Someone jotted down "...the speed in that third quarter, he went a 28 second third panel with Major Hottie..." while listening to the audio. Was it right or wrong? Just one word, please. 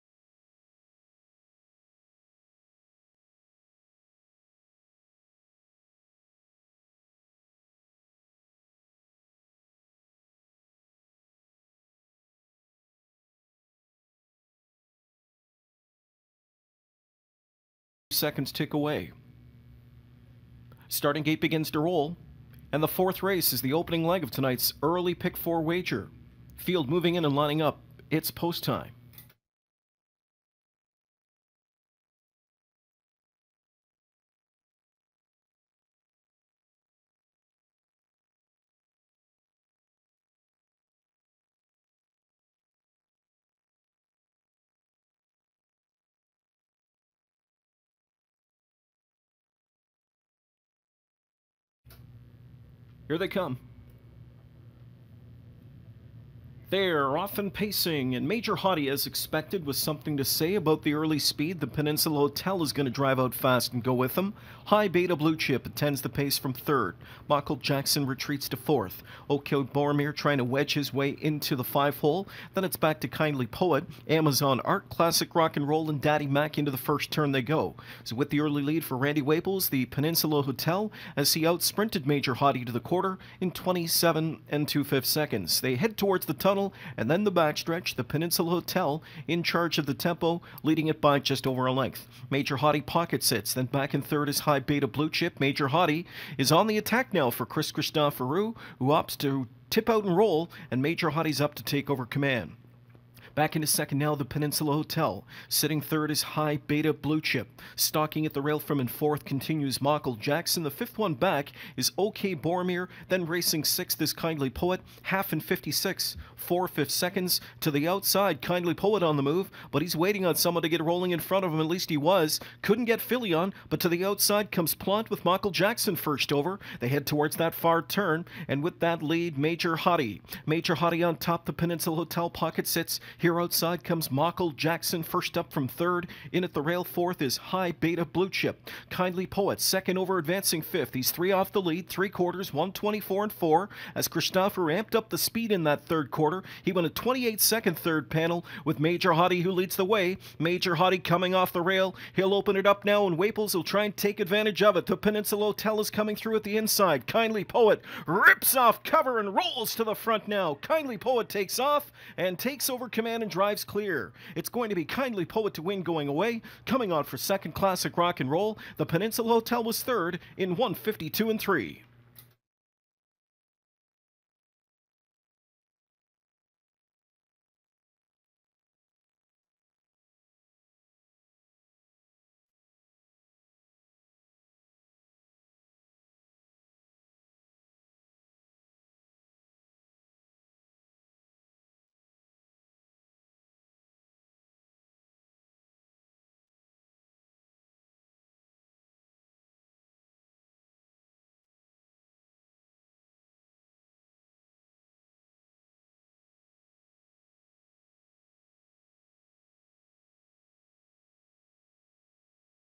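right.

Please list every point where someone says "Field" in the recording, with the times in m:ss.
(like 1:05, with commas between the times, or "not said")
0:26.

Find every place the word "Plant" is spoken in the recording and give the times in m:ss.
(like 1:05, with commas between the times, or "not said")
2:04.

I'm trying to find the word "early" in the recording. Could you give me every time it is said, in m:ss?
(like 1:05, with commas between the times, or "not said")
0:24, 1:00, 1:18.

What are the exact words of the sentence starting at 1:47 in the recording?
Stalking at the rail from in fourth continues Michael Jackson.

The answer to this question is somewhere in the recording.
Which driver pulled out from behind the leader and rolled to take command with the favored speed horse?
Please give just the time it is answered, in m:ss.
1:37.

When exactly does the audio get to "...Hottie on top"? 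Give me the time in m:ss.
2:10.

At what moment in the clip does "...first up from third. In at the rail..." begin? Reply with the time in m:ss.
2:15.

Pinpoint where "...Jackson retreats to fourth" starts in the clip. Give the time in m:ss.
1:07.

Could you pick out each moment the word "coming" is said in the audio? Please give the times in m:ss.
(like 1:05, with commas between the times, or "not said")
2:31, 2:35, 2:46.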